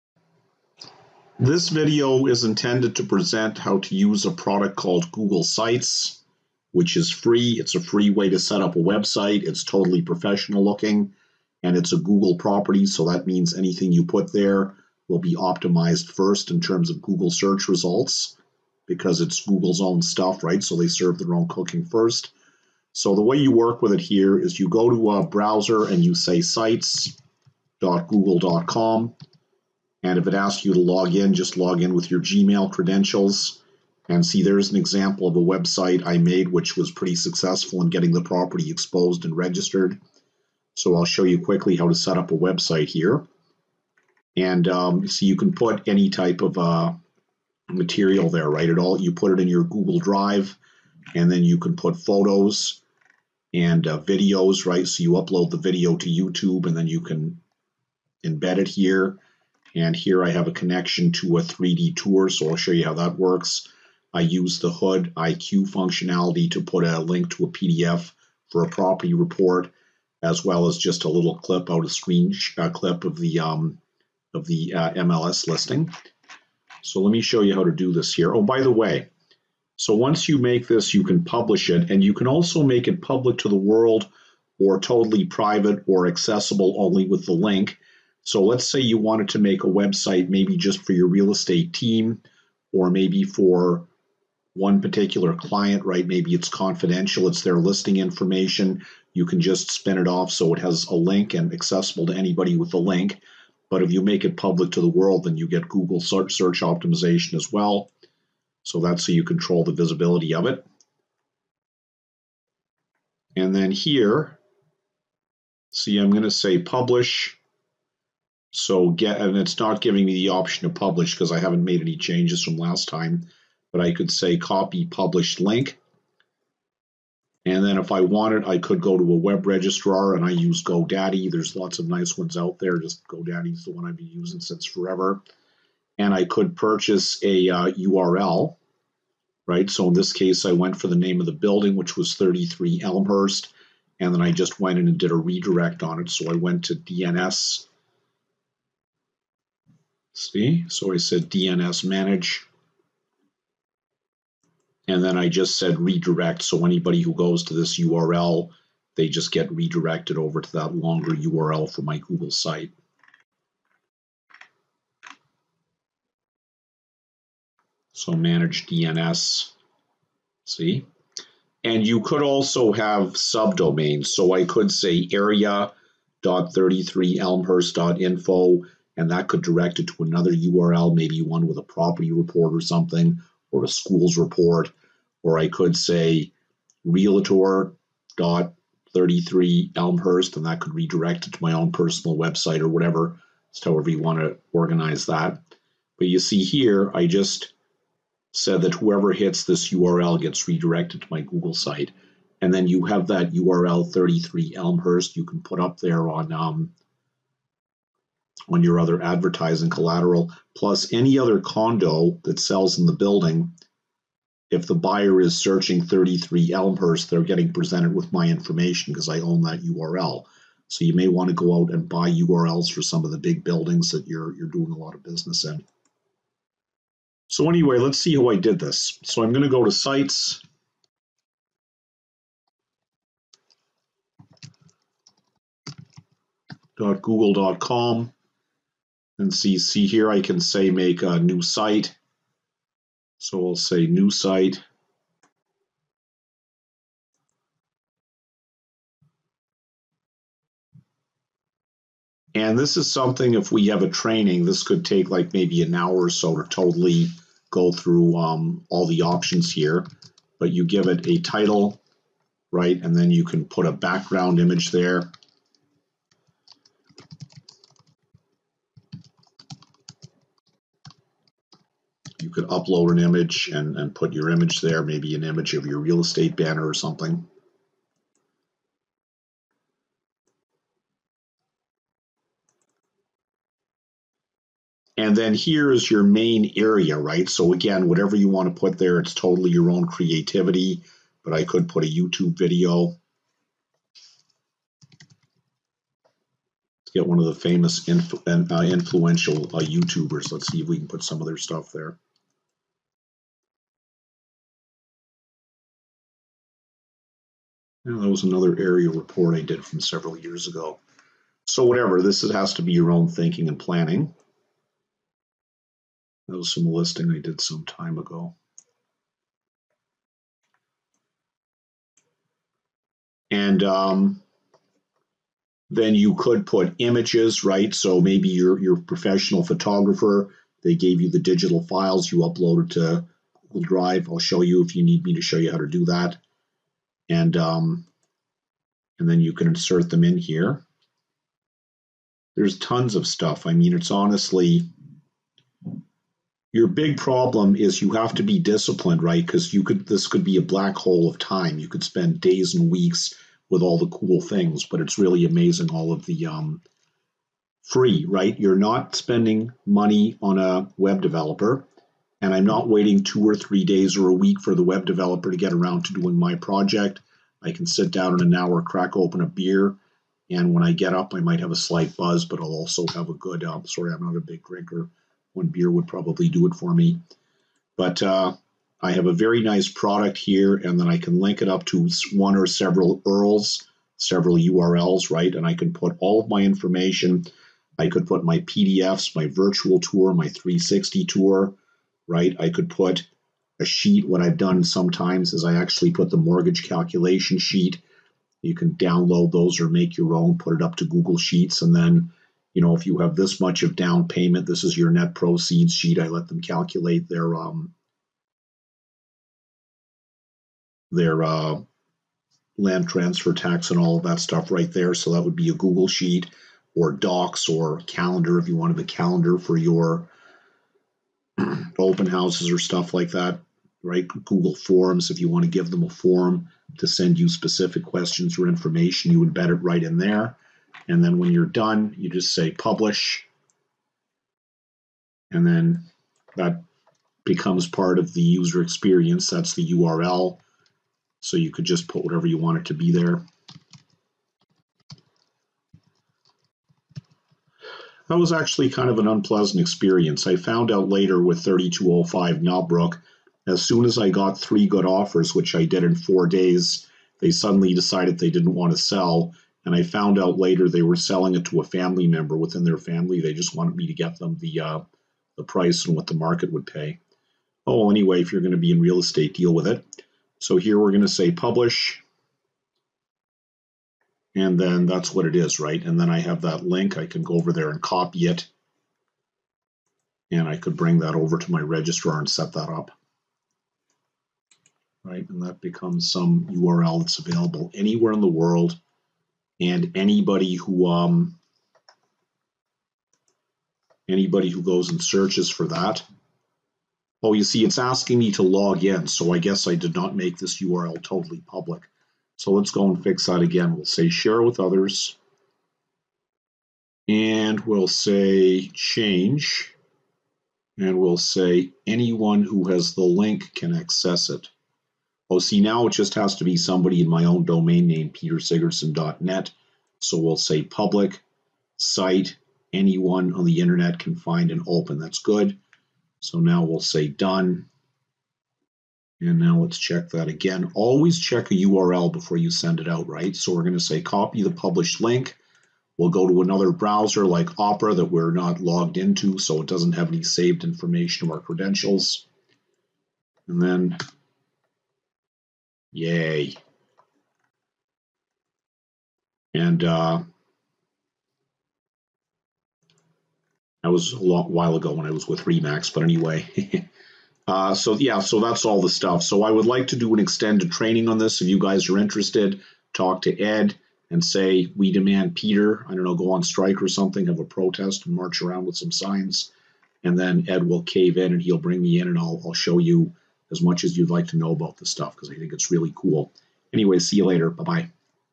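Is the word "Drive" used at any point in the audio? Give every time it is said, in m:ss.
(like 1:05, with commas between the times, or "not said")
0:49, 5:33.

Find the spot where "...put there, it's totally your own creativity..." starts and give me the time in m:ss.
4:48.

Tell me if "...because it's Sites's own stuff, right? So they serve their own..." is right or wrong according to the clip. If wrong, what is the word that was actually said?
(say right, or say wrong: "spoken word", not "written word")
wrong: "Google", not "Sites".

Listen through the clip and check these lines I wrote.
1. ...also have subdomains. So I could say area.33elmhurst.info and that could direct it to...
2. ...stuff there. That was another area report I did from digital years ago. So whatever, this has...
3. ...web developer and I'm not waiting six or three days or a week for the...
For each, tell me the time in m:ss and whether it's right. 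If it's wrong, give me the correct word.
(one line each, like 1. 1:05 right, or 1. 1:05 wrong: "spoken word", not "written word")
1. 2:52 right
2. 5:01 wrong: "several", not "digital"
3. 6:00 wrong: "two", not "six".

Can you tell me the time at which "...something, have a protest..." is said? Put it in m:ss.
9:26.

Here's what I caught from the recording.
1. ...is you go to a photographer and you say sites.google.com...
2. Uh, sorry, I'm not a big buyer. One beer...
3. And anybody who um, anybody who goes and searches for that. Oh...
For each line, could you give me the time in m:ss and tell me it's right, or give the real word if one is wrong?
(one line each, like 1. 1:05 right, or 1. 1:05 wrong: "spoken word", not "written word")
1. 0:24 wrong: "browser", not "photographer"
2. 6:13 wrong: "drinker", not "buyer"
3. 8:09 right.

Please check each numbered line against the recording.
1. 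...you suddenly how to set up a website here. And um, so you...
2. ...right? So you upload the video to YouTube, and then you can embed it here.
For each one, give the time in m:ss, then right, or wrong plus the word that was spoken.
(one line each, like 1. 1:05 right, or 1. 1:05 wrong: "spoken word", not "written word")
1. 0:41 wrong: "quickly", not "suddenly"
2. 0:54 right.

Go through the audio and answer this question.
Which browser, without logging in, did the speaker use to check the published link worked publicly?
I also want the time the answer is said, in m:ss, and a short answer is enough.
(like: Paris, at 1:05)
Opera, at 8:57.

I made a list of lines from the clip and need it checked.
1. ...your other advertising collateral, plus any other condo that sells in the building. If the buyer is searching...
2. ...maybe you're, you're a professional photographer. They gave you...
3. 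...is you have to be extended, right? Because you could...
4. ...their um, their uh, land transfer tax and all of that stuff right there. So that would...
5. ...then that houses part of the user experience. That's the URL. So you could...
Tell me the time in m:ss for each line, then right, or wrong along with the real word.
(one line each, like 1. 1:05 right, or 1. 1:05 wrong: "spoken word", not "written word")
1. 3:28 right
2. 5:27 right
3. 5:47 wrong: "disciplined", not "extended"
4. 6:47 right
5. 7:15 wrong: "becomes", not "houses".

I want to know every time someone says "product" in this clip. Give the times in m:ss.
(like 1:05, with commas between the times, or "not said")
0:04, 6:19.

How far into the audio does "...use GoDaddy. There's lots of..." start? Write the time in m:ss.
2:10.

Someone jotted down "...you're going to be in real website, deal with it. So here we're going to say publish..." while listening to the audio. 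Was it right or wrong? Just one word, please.
wrong.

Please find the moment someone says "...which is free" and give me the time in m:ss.
0:06.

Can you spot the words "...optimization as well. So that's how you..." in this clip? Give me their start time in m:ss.
1:46.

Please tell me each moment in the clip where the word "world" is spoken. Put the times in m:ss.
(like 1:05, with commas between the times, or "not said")
1:23, 1:44, 8:08.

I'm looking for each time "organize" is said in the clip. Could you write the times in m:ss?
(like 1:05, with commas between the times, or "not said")
3:14.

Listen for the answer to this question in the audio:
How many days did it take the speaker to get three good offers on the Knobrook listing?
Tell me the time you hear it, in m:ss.
7:35.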